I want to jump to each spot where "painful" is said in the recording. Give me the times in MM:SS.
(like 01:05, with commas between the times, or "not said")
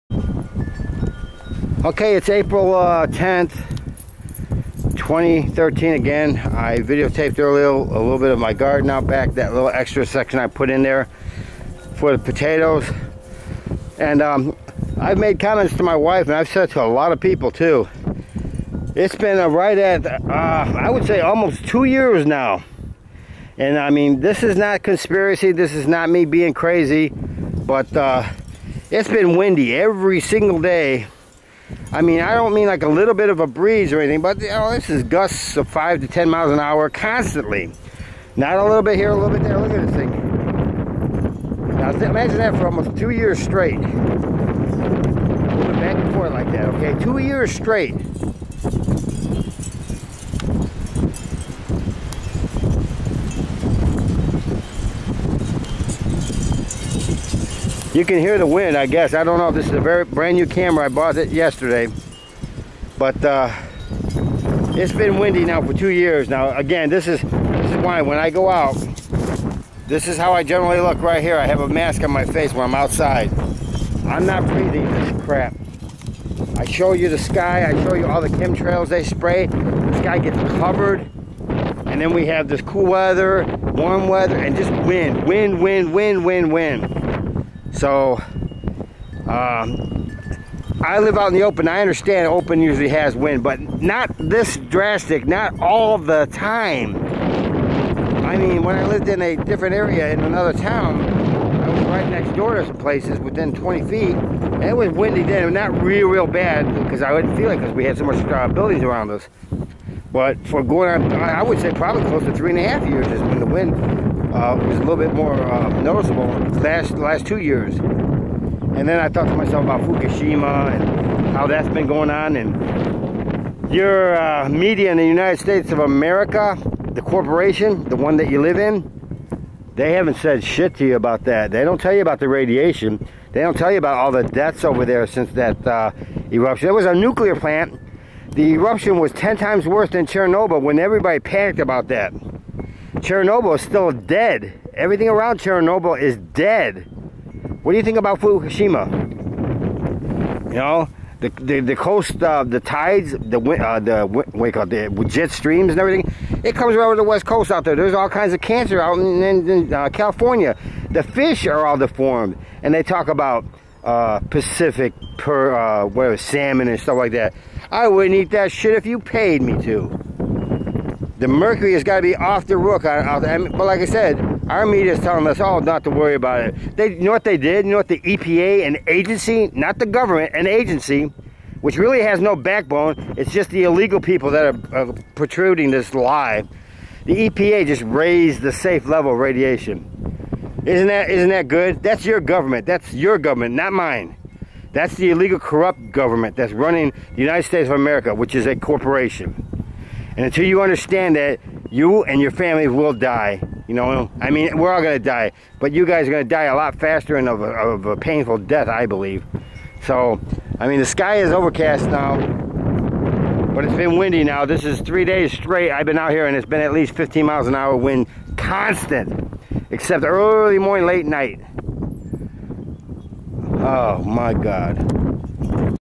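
03:27.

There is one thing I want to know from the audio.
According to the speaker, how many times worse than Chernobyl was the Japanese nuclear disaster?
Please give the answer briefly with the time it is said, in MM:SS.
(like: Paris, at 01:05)
10 times, at 02:19.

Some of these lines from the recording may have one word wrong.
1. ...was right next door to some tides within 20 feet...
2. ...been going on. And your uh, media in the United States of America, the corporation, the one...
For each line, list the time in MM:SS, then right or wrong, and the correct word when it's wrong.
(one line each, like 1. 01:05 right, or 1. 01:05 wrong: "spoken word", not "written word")
1. 01:41 wrong: "places", not "tides"
2. 02:01 right.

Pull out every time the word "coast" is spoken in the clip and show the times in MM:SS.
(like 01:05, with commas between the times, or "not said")
02:31, 02:37.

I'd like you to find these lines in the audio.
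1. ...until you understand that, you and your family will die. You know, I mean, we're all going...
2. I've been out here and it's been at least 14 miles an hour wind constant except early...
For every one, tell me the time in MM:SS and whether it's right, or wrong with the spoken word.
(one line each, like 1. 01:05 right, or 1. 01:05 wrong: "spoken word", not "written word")
1. 03:20 right
2. 03:35 wrong: "15", not "14".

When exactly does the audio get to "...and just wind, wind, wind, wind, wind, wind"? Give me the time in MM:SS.
01:24.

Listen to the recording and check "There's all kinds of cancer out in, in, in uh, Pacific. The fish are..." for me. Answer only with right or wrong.
wrong.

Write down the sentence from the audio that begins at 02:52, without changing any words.
but like I said, our media is telling us all not to worry about it.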